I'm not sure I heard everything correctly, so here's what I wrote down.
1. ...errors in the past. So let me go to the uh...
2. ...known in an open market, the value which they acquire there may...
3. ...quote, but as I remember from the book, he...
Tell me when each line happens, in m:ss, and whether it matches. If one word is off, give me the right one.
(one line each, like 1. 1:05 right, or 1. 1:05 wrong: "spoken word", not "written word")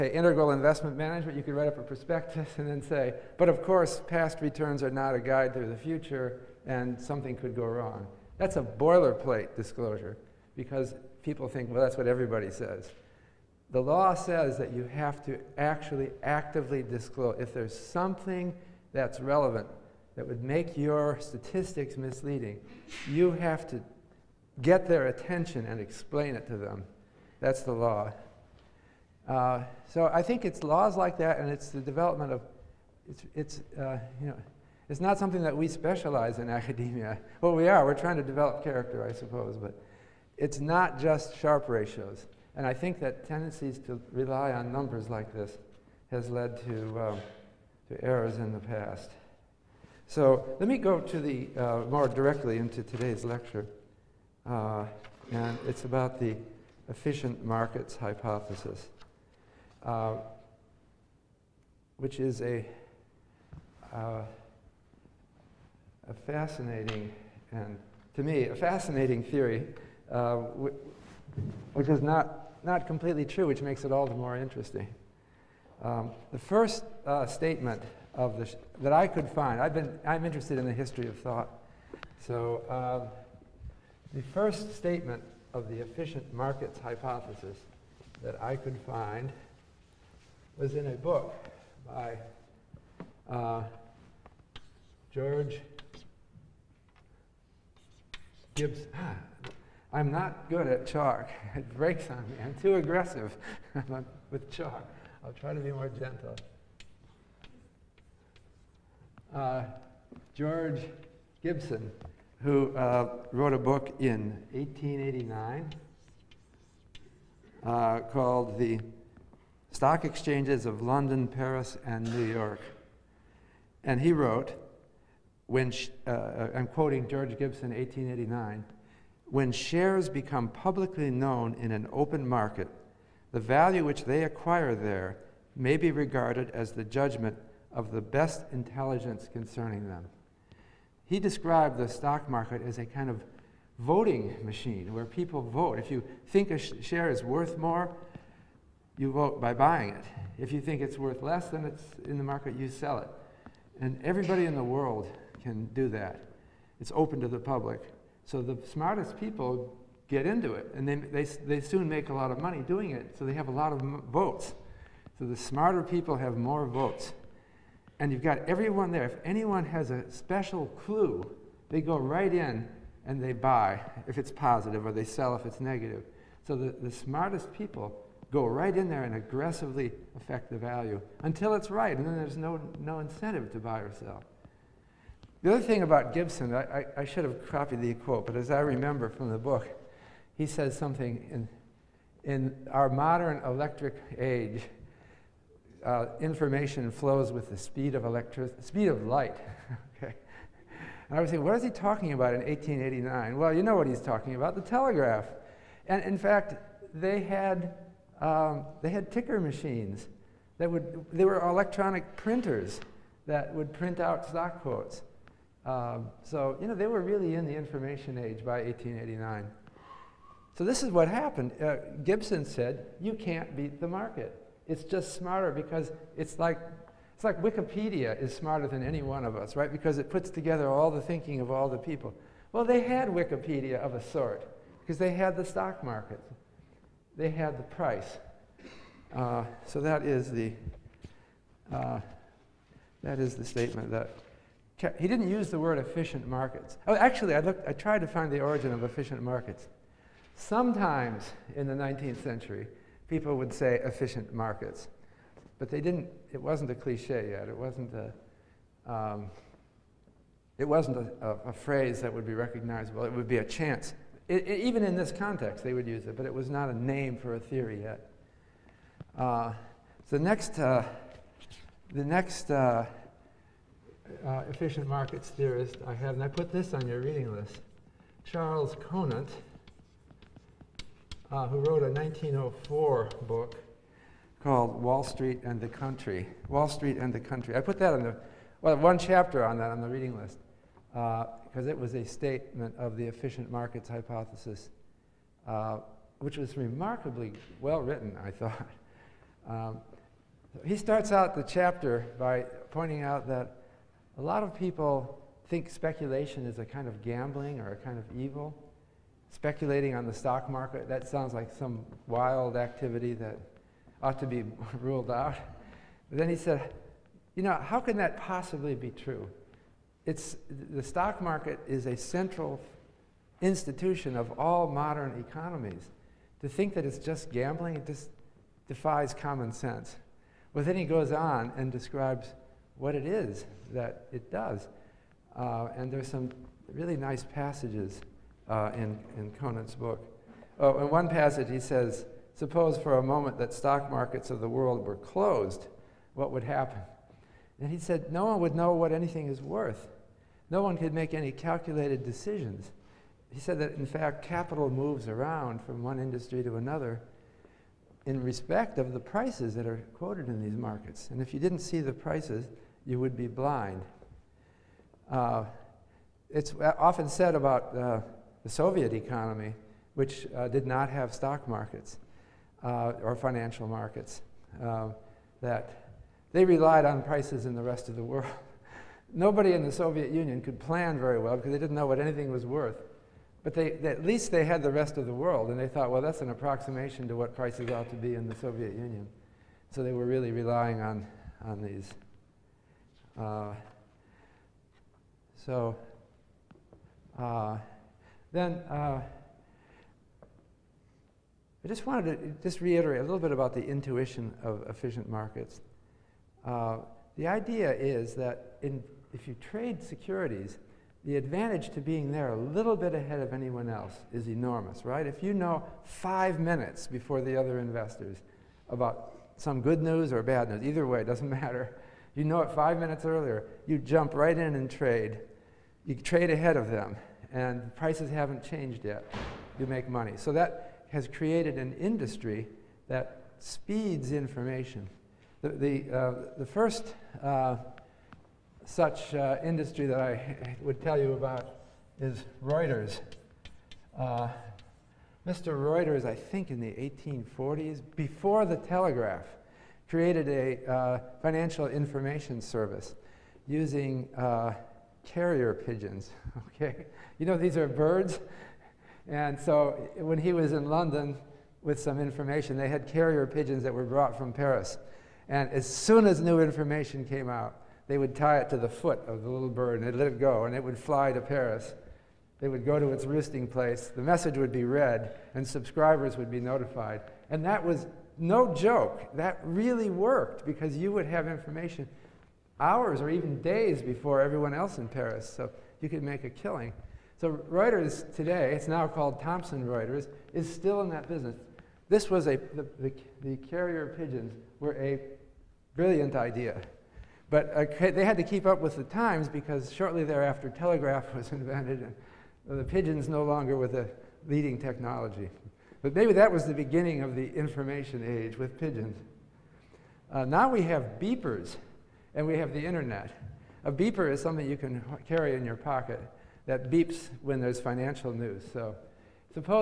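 1. 0:48 right
2. 2:11 right
3. 3:07 right.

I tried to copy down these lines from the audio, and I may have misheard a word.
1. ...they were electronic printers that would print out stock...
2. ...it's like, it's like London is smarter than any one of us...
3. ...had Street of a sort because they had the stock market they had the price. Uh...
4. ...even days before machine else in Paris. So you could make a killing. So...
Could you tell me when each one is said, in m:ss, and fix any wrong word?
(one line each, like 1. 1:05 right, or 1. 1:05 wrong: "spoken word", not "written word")
1. 3:31 right
2. 3:46 wrong: "Wikipedia", not "London"
3. 3:52 wrong: "Wikipedia", not "Street"
4. 8:03 wrong: "everyone", not "machine".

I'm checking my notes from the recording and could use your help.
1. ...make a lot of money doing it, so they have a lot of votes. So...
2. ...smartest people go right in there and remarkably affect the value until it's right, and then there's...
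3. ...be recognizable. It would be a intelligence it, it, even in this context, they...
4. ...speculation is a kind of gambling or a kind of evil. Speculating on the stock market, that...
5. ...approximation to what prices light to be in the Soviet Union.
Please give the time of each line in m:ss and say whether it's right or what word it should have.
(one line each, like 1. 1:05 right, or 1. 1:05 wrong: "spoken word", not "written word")
1. 2:41 right
2. 2:56 wrong: "aggressively", not "remarkably"
3. 4:22 wrong: "chance", not "intelligence"
4. 5:05 right
5. 6:26 wrong: "ought", not "light".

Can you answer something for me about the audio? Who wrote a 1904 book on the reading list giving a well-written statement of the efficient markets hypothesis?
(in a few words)
Charles Conant.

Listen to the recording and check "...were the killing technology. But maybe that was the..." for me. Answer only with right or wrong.
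wrong.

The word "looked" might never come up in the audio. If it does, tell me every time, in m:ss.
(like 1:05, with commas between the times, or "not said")
4:07.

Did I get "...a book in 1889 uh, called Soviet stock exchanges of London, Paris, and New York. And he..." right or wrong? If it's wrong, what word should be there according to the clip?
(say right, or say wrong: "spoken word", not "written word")
wrong: "The", not "Soviet".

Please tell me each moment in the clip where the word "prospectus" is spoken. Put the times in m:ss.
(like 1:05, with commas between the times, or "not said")
0:01.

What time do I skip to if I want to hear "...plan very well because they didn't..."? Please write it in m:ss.
6:20.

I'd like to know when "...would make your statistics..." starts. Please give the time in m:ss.
0:20.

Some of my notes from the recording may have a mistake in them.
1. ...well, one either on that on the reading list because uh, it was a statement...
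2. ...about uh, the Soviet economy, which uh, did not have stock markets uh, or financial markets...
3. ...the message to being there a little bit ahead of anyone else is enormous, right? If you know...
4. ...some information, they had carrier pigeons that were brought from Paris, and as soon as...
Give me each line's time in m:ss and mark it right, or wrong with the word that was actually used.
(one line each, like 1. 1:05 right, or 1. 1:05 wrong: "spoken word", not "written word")
1. 4:48 wrong: "chapter", not "either"
2. 6:07 right
3. 6:51 wrong: "advantage", not "message"
4. 7:41 right.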